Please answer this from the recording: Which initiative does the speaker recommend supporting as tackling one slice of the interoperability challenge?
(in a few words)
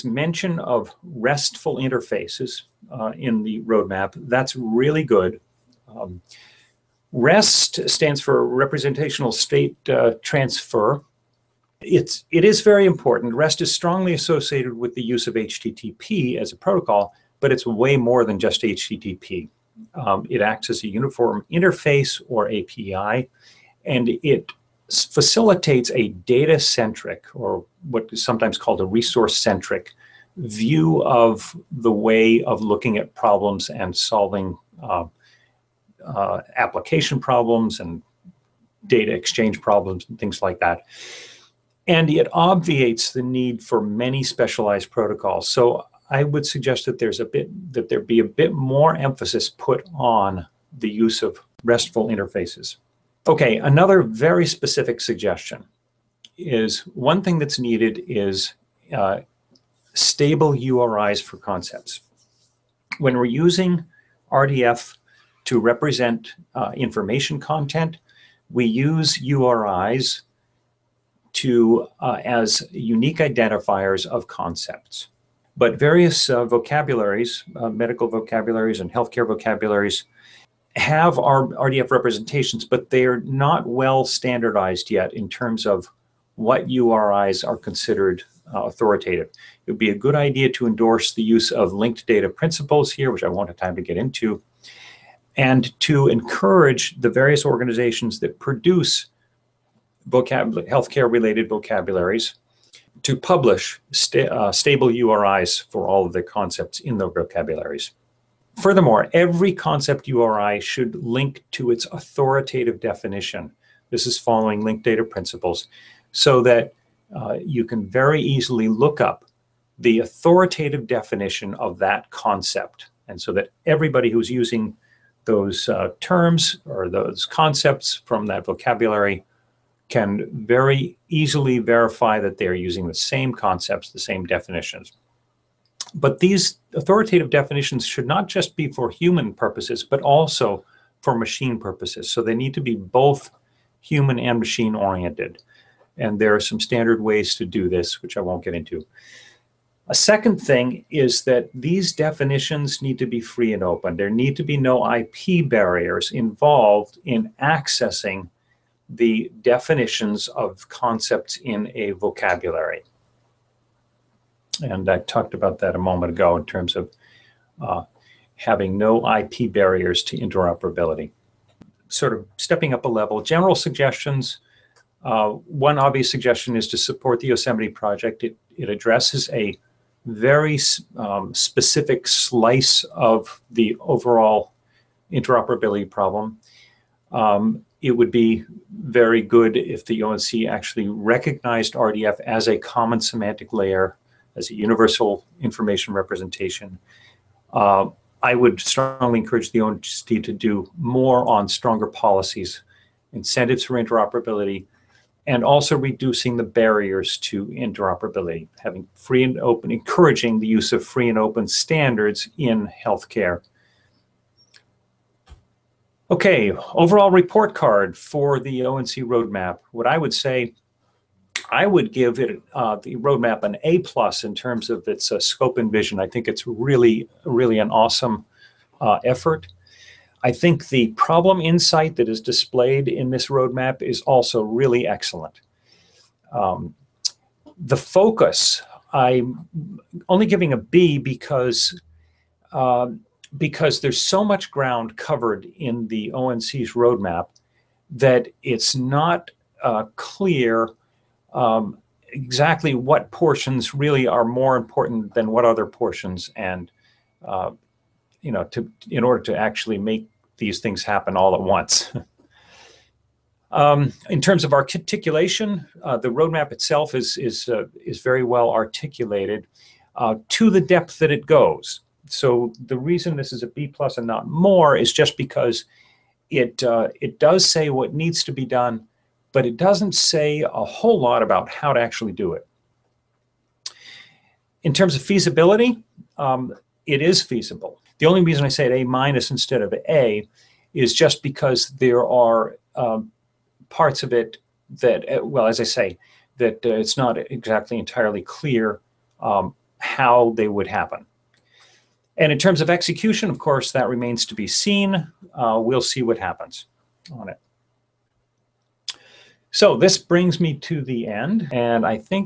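Yosemite Project.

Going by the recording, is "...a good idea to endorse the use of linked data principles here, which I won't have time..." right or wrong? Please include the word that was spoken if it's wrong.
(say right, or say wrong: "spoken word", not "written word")
right.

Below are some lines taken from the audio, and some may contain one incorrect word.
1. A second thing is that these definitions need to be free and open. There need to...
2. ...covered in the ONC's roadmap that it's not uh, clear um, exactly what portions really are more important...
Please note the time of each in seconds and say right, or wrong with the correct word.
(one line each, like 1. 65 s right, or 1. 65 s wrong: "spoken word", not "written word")
1. 149 s right
2. 244 s right.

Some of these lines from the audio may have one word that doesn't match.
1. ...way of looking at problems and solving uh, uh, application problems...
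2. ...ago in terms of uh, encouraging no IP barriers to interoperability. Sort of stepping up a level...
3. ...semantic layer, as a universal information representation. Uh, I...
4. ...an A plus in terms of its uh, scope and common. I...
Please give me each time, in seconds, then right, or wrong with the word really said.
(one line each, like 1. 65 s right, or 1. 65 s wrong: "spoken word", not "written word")
1. 31 s right
2. 166 s wrong: "having", not "encouraging"
3. 193 s right
4. 223 s wrong: "vision", not "common".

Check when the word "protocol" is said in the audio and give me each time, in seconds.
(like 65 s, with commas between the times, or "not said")
16 s, 44 s.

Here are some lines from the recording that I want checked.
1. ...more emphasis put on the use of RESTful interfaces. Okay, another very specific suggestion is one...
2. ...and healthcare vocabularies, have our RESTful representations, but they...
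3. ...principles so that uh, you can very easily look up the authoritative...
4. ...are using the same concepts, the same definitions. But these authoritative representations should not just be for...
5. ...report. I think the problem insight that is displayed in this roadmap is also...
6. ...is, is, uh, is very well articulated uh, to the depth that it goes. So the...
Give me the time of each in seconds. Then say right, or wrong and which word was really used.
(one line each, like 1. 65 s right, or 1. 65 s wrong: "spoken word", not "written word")
1. 48 s right
2. 78 s wrong: "RDF", not "RESTful"
3. 115 s right
4. 132 s wrong: "definitions", not "representations"
5. 229 s wrong: "effort", not "report"
6. 266 s right.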